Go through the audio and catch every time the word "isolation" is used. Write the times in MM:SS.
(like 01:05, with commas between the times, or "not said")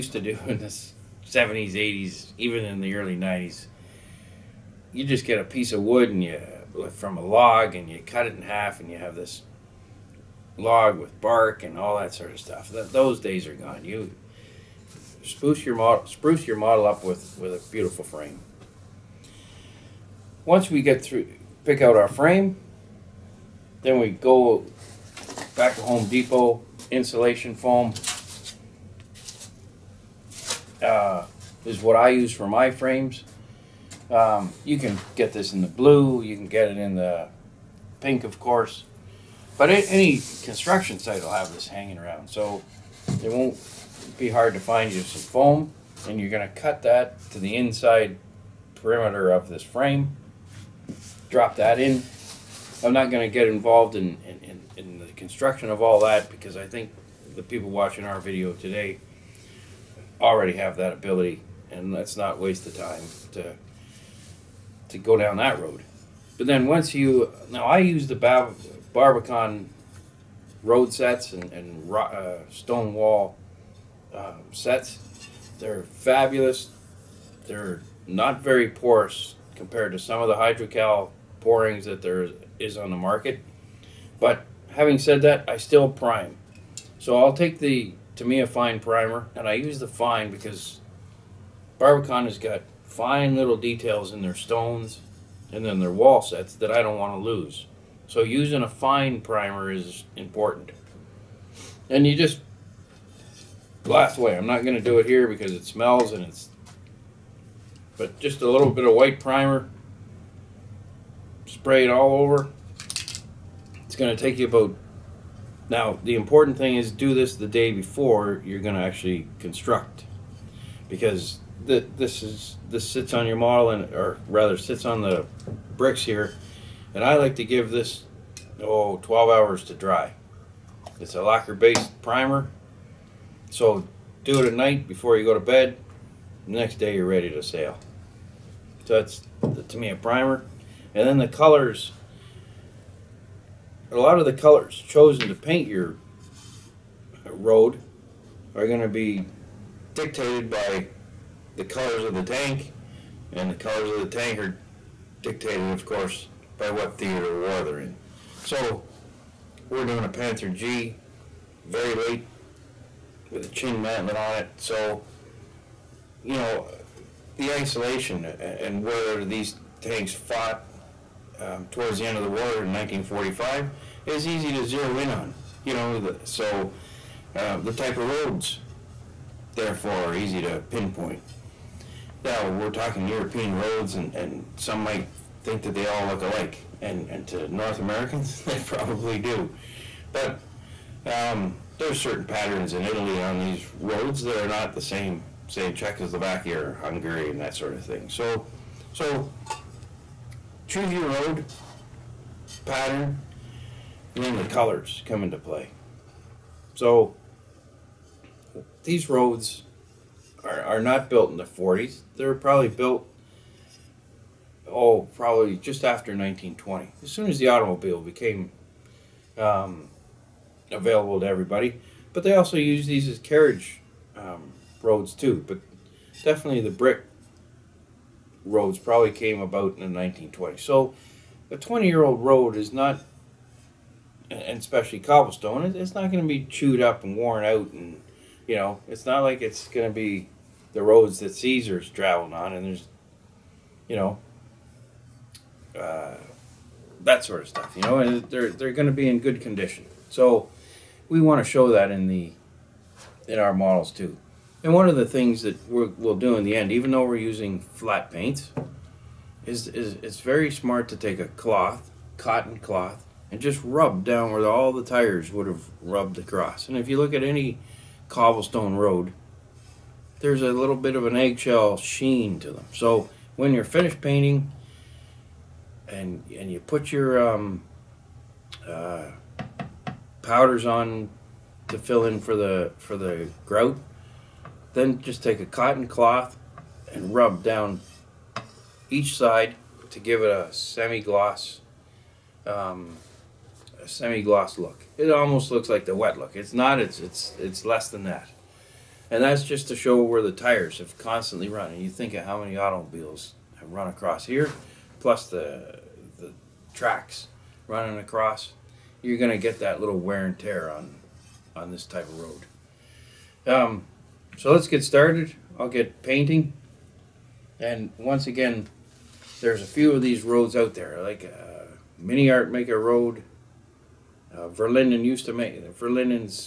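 02:47.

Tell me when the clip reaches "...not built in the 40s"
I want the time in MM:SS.
03:30.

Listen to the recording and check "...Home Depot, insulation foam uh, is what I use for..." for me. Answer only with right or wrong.
right.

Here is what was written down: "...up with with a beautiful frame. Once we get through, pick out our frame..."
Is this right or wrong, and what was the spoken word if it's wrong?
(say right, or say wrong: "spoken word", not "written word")
right.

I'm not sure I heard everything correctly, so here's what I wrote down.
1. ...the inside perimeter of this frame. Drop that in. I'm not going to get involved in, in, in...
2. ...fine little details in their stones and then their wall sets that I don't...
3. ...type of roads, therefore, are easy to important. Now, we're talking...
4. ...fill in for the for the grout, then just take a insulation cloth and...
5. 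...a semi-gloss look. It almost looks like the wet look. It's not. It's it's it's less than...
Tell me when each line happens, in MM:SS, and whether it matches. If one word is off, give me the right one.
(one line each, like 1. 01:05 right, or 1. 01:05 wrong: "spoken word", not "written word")
1. 00:47 right
2. 01:32 right
3. 02:57 wrong: "pinpoint", not "important"
4. 04:41 wrong: "cotton", not "insulation"
5. 04:53 right.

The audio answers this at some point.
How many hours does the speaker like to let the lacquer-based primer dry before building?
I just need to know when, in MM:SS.
02:08.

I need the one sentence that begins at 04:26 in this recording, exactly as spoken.
And if you look at any cobblestone road, there's a little bit of an eggshell sheen to them.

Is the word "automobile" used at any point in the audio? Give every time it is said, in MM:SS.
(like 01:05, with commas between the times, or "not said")
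03:37, 05:02.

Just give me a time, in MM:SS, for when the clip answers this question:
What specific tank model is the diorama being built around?
02:40.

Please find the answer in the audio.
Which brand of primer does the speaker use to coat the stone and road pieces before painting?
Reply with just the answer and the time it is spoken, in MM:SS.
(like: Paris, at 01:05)
Tamiya Fine Primer, at 01:28.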